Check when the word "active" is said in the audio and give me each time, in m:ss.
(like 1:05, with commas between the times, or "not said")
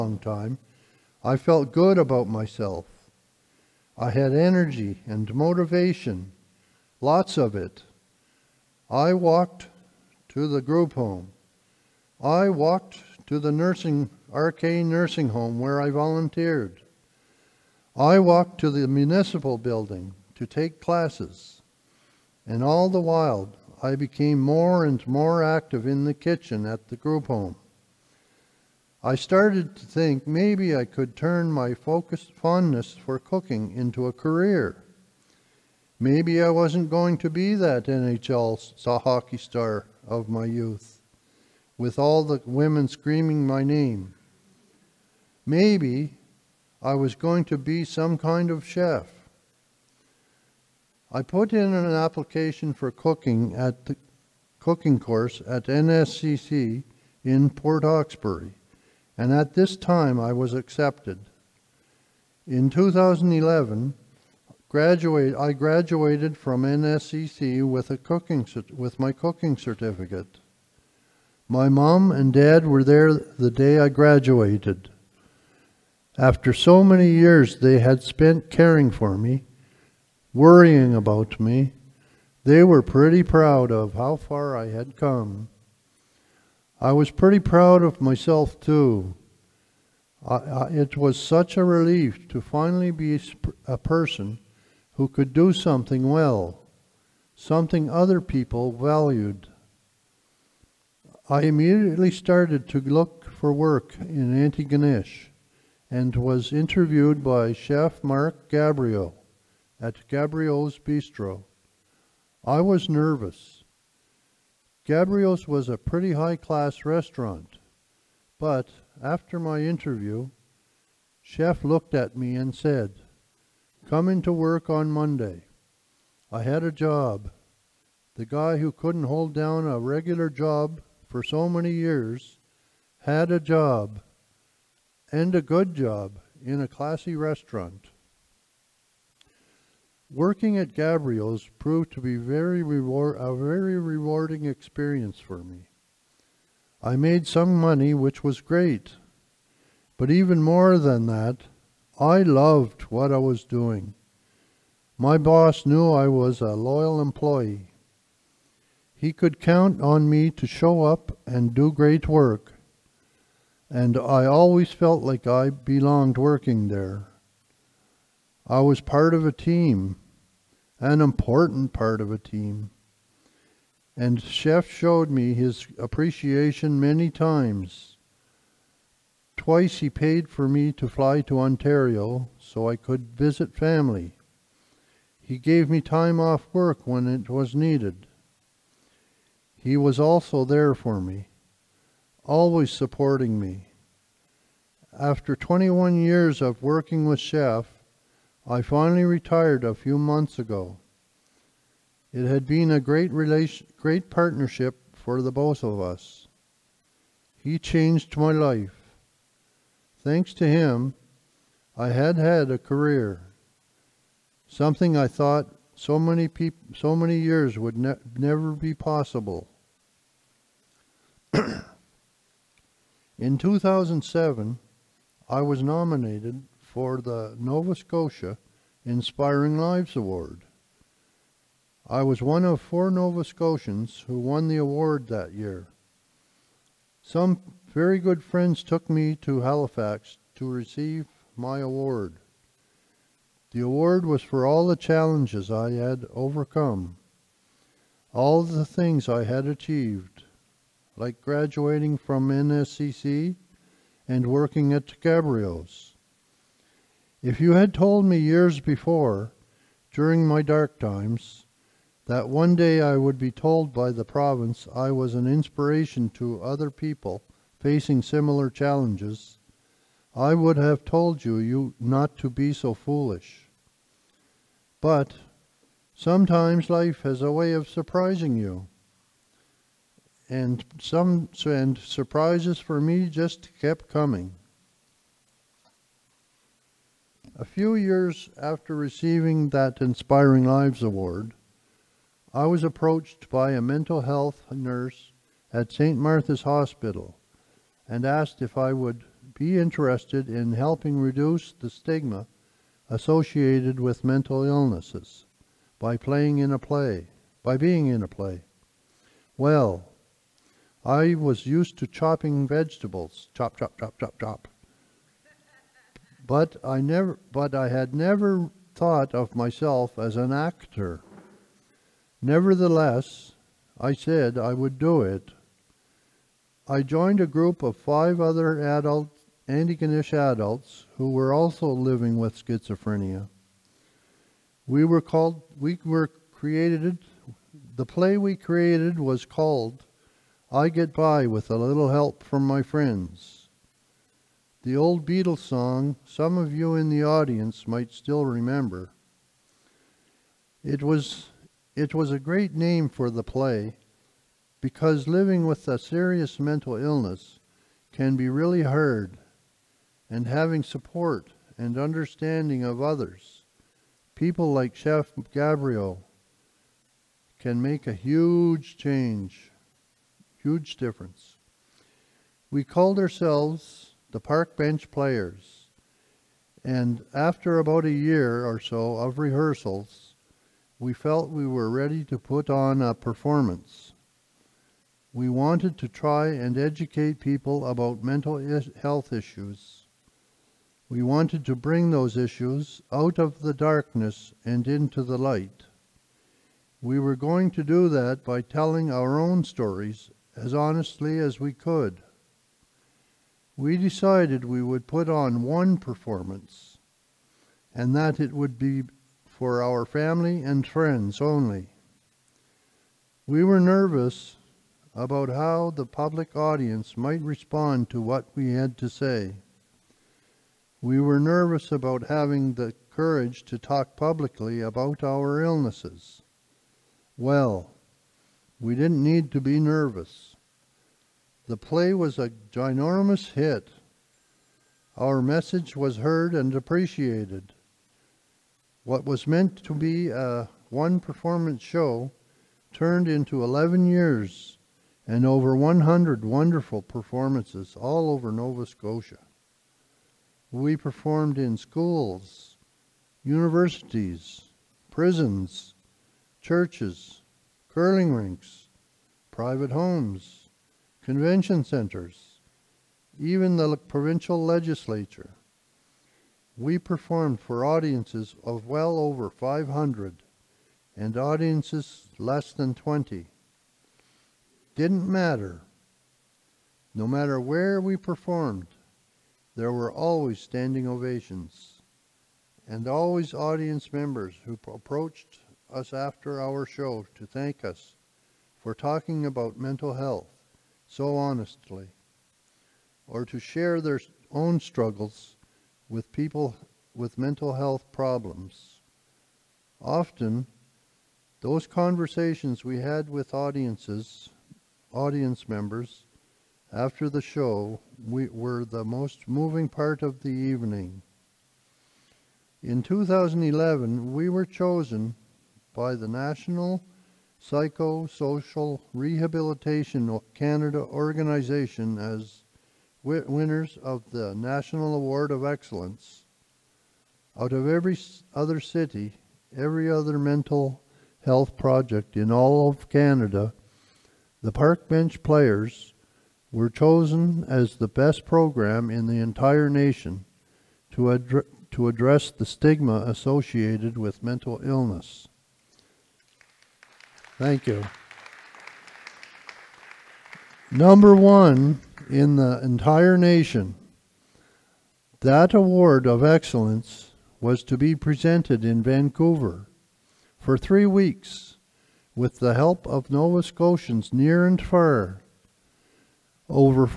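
0:25.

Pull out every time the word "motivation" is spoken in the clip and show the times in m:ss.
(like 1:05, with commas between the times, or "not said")
0:05.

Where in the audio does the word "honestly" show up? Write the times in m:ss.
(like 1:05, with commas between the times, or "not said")
6:40, 8:11.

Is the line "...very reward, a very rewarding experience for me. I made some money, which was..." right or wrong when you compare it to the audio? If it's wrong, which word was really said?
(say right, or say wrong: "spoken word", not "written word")
right.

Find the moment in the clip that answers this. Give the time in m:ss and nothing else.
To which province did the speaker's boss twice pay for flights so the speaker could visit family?
3:01.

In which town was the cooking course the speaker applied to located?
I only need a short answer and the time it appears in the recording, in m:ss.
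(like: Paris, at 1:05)
Port Hawkesbury, at 0:57.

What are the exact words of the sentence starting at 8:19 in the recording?
Often, those conversations we had with audiences, audience members, after the show we were the most moving part of the evening.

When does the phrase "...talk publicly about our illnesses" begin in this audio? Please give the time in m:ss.
7:03.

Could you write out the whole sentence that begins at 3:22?
It had been a great, relation, great partnership for the both of us.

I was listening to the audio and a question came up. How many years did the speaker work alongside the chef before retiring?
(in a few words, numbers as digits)
21.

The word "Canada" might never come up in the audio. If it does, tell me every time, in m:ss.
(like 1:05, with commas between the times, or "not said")
8:40, 8:52.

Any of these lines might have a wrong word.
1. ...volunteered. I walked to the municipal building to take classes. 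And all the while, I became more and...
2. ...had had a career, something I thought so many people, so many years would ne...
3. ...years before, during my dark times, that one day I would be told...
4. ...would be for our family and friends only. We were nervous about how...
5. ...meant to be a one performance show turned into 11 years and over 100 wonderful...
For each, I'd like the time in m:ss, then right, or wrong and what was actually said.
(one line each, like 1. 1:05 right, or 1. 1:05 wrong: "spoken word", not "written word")
1. 0:15 right
2. 3:31 right
3. 4:18 right
4. 6:48 right
5. 7:19 right.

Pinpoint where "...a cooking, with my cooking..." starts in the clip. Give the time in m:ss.
1:07.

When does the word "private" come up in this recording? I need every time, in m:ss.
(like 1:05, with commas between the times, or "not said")
7:39.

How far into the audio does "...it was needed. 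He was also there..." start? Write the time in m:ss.
3:07.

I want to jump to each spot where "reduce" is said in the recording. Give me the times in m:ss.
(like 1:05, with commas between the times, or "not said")
5:00.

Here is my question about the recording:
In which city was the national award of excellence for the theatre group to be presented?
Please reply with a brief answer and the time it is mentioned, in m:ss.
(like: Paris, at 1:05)
Vancouver, at 9:18.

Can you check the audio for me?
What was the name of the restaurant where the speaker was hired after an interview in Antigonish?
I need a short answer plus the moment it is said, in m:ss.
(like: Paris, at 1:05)
Gabriel's Bistro, at 1:50.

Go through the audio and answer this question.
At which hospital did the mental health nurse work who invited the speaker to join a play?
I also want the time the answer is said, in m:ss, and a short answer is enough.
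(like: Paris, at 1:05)
St. Martha's Hospital, at 4:55.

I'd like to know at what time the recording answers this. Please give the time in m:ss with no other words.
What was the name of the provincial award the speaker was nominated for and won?
3:47.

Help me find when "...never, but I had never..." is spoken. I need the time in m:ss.
5:16.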